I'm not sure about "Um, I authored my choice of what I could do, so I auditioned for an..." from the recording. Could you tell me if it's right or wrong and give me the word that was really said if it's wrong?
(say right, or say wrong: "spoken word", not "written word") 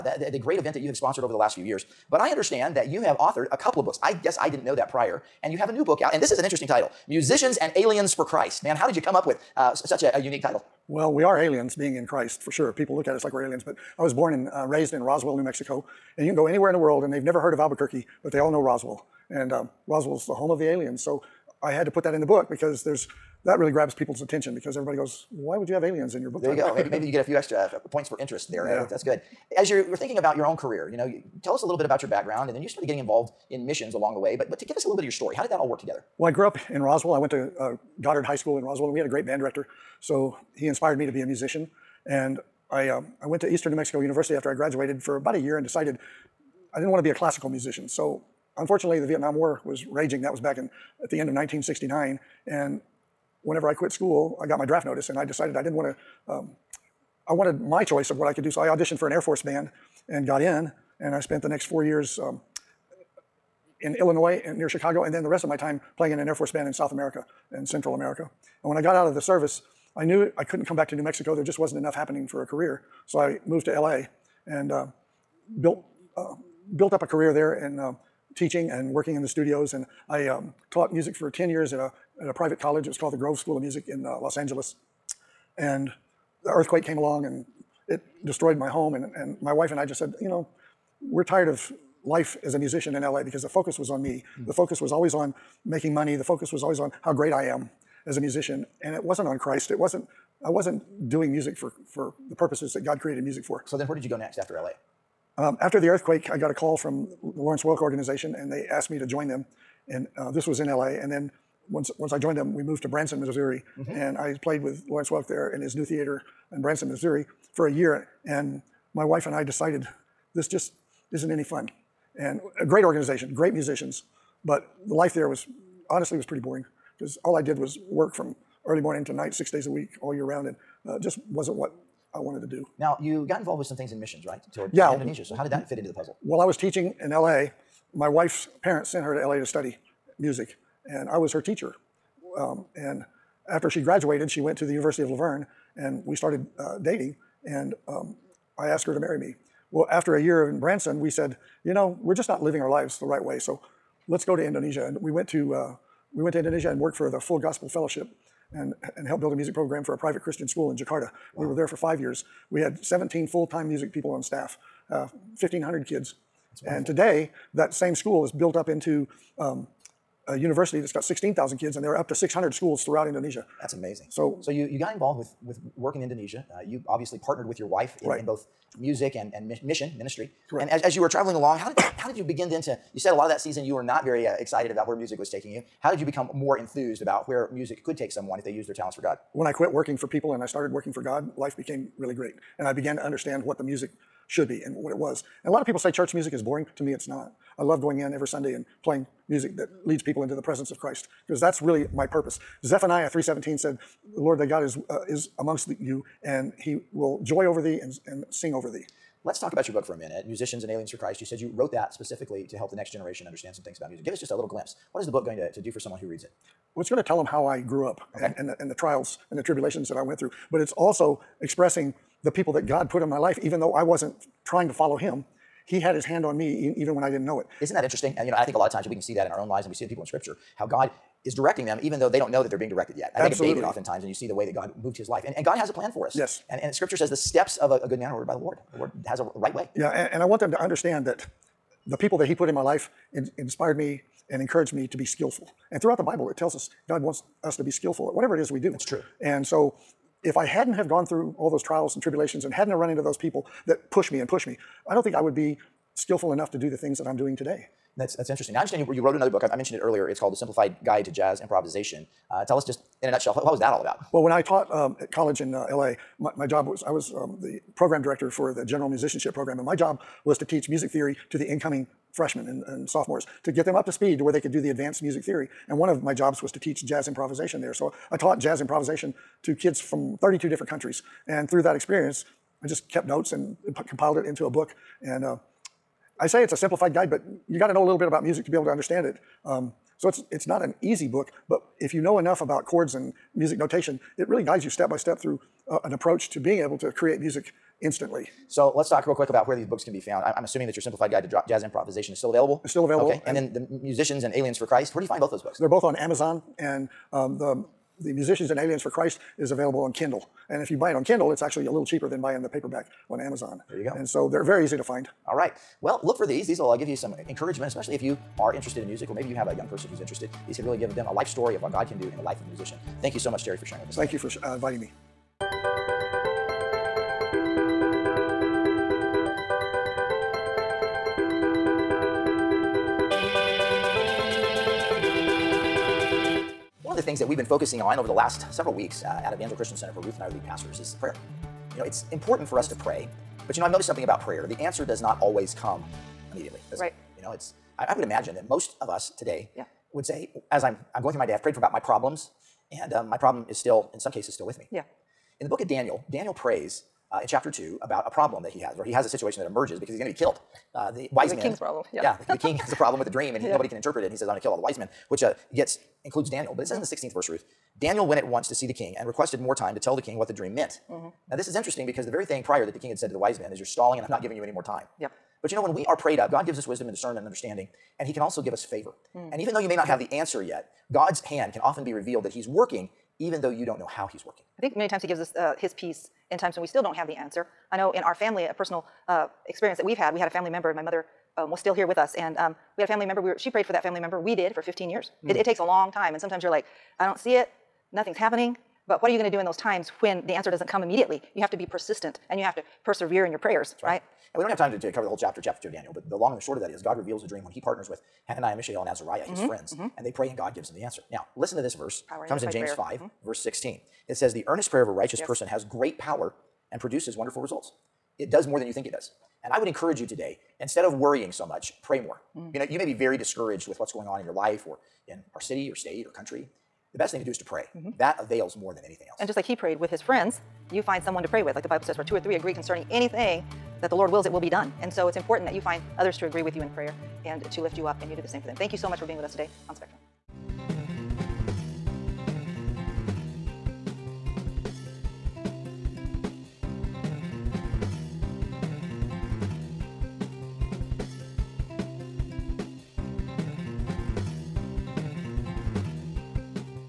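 wrong: "wanted", not "authored".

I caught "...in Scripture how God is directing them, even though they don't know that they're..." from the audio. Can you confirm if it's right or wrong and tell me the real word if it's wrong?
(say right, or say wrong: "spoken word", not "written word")
right.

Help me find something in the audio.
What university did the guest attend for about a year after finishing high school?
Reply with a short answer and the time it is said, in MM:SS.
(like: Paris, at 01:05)
Eastern New Mexico University, at 00:43.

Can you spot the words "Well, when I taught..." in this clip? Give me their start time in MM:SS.
04:24.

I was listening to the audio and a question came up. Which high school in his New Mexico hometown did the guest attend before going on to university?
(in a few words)
Goddard High School.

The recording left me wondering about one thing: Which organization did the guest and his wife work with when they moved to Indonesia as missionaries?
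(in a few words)
Full Gospel Fellowship.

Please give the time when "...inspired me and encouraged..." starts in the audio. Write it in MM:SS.
04:03.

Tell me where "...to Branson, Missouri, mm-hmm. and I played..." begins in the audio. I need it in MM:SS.
01:52.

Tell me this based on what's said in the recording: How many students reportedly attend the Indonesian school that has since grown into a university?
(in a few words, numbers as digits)
16,000.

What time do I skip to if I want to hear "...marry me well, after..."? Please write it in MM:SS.
02:28.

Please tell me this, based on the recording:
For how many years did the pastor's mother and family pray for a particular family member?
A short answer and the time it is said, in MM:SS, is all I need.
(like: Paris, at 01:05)
15, at 06:34.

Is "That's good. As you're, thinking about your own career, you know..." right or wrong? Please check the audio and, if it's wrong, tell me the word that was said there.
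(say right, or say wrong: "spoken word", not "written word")
right.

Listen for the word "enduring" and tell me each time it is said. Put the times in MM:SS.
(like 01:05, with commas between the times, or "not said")
not said.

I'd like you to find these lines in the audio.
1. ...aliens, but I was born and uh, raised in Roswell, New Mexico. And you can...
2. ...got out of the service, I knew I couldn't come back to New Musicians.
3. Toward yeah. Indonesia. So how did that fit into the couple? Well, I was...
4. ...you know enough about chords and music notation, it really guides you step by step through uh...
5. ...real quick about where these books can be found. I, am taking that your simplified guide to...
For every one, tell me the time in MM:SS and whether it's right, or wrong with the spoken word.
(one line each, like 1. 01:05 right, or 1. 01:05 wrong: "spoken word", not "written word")
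1. 00:13 right
2. 01:08 wrong: "Mexico", not "Musicians"
3. 02:14 wrong: "puzzle", not "couple"
4. 04:51 right
5. 04:59 wrong: "assuming", not "taking".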